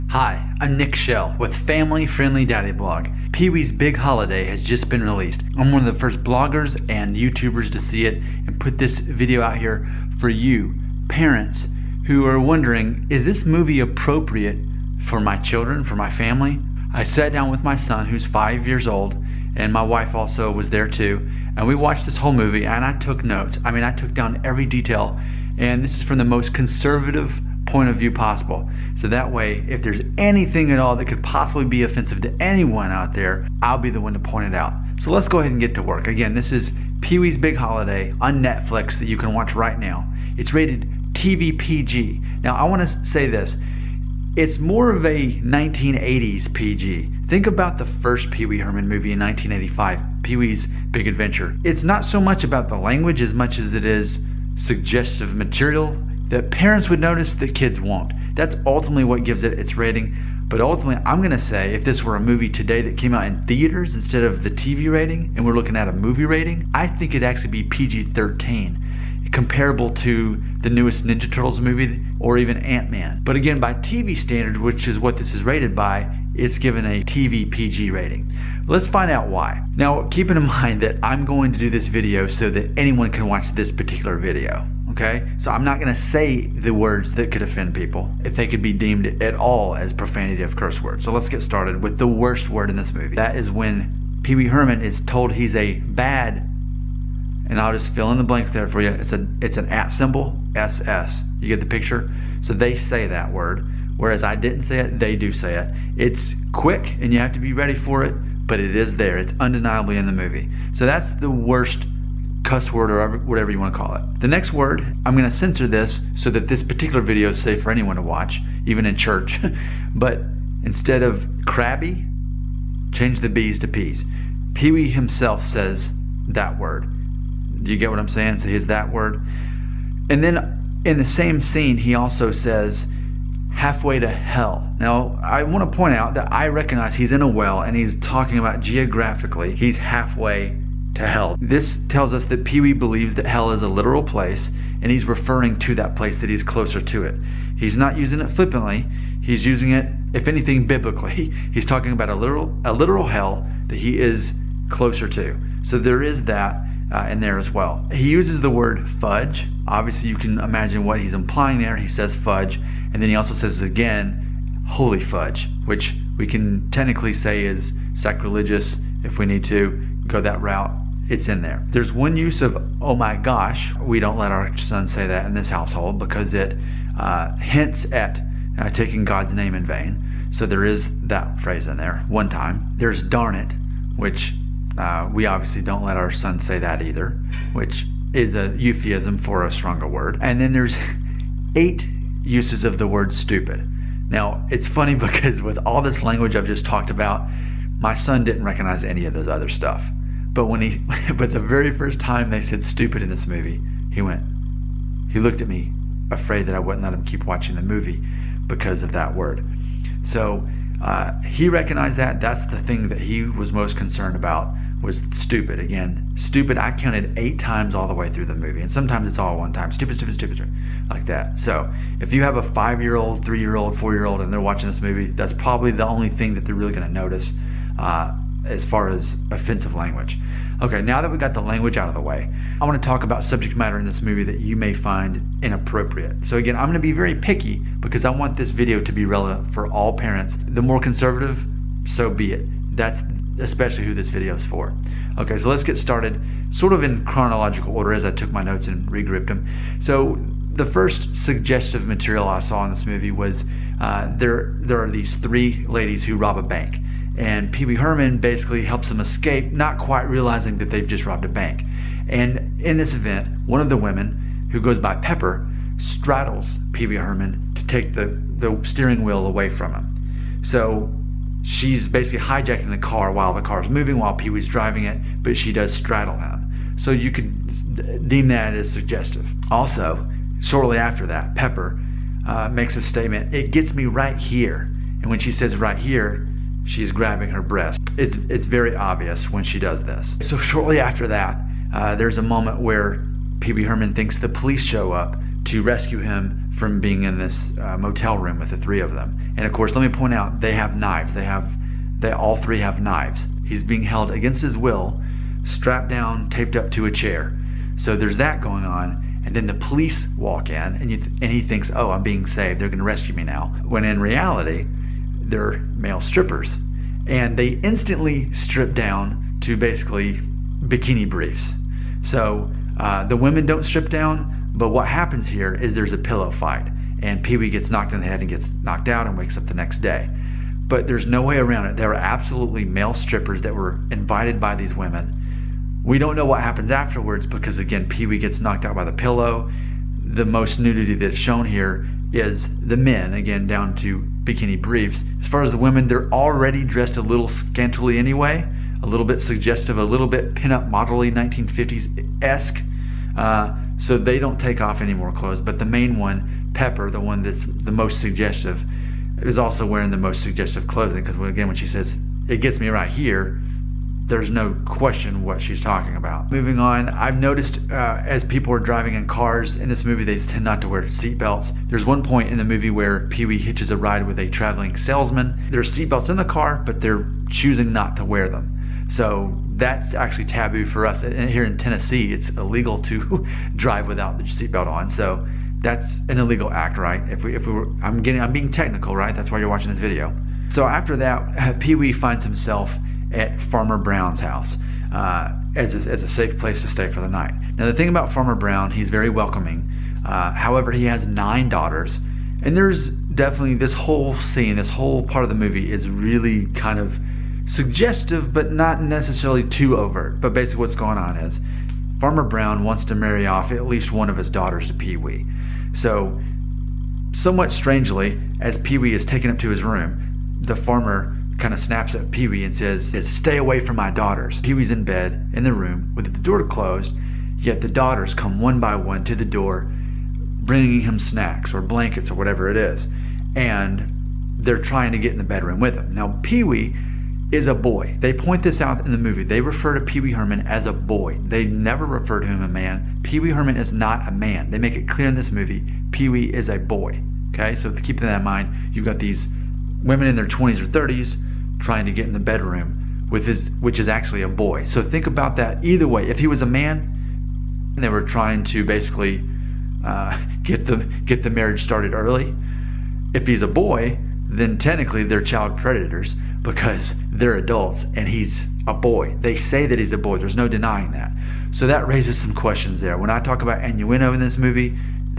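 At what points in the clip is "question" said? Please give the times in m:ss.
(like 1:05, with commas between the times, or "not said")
6:04, 7:52.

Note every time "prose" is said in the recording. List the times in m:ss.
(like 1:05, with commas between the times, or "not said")
not said.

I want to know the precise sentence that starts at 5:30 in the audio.
But there's no way around it.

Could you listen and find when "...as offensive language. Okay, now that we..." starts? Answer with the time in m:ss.
3:48.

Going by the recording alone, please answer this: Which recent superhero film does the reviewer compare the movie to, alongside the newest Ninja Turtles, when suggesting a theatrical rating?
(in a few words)
Ant Man.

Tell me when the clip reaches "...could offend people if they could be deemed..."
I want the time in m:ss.
1:27.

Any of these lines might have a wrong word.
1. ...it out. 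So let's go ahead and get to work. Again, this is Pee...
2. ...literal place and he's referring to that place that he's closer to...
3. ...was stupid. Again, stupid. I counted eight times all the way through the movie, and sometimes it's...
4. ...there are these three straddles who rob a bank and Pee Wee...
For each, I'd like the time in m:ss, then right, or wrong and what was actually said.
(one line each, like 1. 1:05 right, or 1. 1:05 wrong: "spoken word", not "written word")
1. 0:34 right
2. 2:23 right
3. 3:34 right
4. 4:14 wrong: "ladies", not "straddles".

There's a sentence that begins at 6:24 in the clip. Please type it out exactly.
So that's an illegal act, right?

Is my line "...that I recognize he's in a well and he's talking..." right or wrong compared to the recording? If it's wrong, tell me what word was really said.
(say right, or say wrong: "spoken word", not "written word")
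right.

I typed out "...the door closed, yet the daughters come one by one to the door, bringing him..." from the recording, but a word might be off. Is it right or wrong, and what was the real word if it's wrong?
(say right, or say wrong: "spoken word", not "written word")
right.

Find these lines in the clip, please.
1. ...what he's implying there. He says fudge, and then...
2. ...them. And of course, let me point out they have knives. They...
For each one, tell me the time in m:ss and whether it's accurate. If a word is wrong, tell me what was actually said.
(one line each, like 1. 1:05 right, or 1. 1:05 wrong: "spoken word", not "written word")
1. 2:40 right
2. 4:58 right.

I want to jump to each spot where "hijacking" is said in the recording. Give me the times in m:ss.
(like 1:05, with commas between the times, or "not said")
4:32.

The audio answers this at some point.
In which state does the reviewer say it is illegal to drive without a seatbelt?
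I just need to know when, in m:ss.
6:21.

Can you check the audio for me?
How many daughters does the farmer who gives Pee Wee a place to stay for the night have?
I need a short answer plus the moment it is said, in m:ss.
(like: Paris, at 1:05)
9, at 6:41.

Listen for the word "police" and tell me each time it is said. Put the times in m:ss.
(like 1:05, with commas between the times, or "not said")
4:54, 5:09.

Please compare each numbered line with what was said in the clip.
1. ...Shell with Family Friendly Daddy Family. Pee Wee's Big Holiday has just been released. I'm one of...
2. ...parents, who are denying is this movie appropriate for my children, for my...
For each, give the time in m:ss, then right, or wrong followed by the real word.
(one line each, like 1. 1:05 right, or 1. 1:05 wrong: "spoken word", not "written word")
1. 0:00 wrong: "Blog", not "Family"
2. 0:11 wrong: "wondering", not "denying".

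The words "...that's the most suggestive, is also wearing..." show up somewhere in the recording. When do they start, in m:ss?
5:57.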